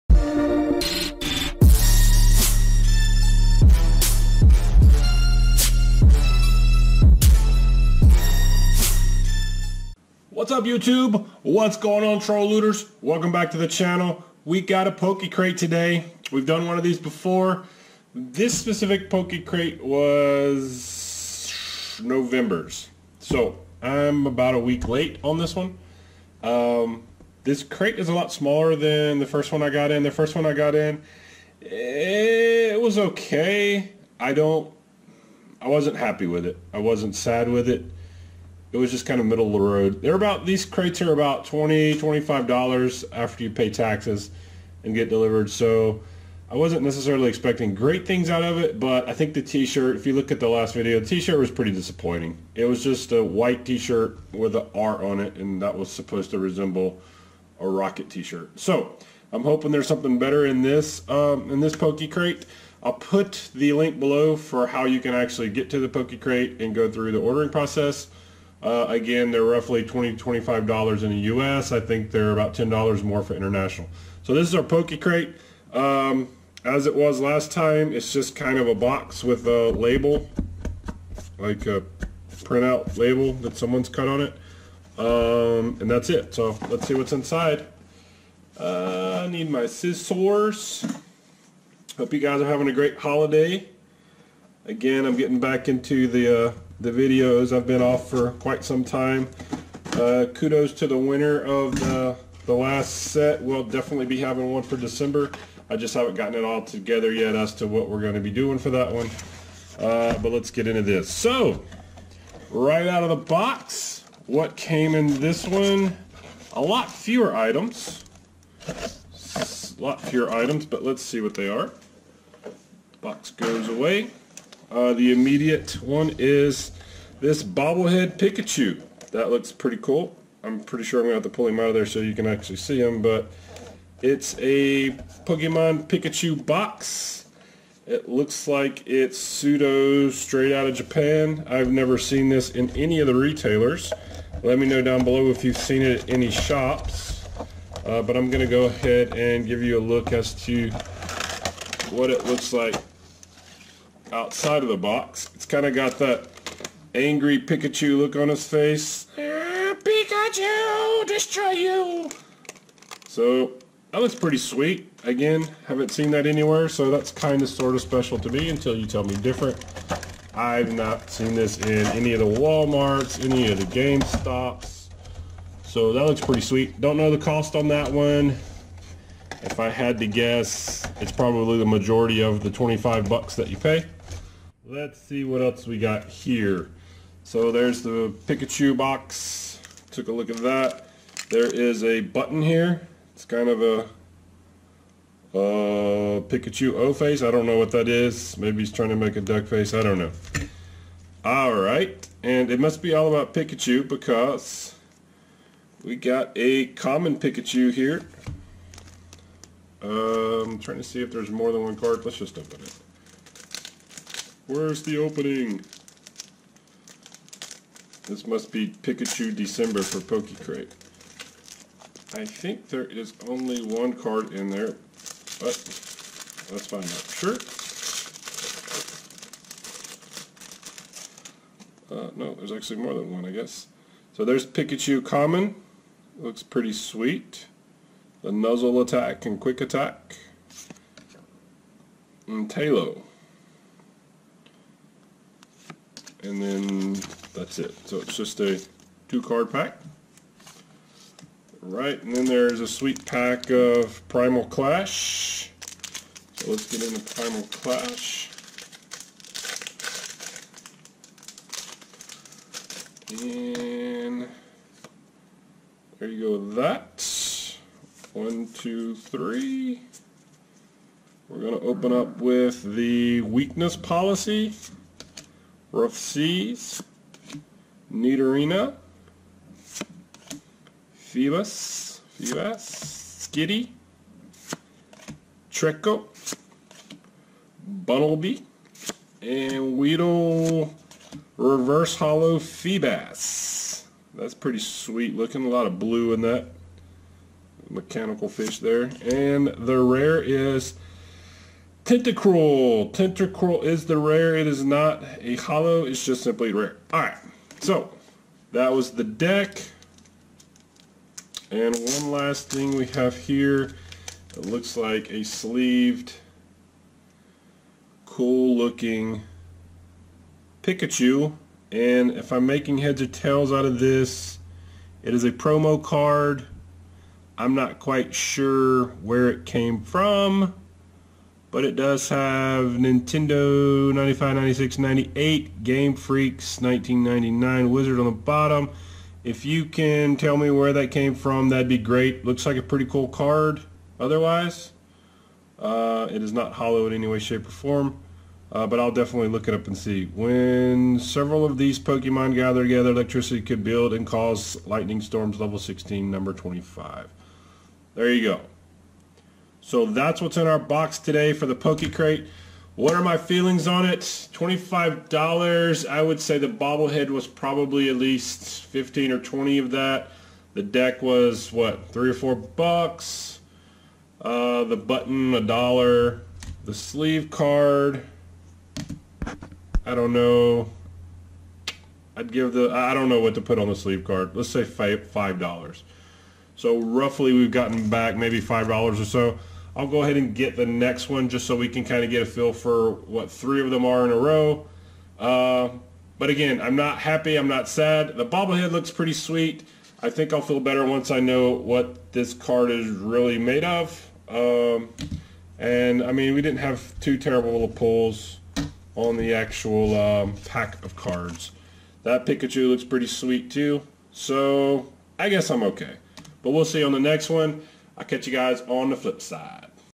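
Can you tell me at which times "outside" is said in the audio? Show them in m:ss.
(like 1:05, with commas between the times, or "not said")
2:34.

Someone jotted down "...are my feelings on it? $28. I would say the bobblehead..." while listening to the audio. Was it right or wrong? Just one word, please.
wrong.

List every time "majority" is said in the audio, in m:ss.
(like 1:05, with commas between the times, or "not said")
3:01.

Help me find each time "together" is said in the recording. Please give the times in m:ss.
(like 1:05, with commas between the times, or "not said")
1:46, 5:52.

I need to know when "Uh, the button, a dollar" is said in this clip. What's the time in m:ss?
6:14.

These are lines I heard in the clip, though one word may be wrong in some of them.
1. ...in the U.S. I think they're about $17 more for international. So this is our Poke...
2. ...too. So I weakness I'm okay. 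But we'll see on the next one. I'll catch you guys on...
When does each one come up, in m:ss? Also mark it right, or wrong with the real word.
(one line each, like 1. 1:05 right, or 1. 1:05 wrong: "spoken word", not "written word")
1. 1:11 wrong: "10", not "17"
2. 6:53 wrong: "guess", not "weakness".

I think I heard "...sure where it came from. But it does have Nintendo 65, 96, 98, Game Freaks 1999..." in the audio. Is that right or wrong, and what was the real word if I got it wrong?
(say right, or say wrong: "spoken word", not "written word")
wrong: "95", not "65".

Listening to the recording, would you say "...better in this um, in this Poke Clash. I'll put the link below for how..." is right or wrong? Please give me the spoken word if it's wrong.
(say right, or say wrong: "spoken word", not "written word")
wrong: "Crate", not "Clash".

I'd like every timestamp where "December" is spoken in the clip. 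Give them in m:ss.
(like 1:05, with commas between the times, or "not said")
1:44, 3:39.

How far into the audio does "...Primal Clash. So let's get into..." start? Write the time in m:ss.
4:14.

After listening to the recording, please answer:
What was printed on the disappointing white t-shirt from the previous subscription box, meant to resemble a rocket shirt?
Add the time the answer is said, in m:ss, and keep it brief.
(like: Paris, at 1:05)
an R, at 0:54.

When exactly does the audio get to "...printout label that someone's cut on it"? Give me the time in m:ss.
1:22.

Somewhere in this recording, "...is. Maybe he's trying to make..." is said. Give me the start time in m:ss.
3:17.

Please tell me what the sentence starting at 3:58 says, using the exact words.
The Nuzzle Attack and Quick Attack.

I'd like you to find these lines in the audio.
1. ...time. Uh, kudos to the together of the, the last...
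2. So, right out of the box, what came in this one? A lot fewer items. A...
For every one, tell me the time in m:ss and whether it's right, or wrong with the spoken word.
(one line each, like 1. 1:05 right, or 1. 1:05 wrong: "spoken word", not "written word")
1. 1:38 wrong: "winner", not "together"
2. 1:51 right.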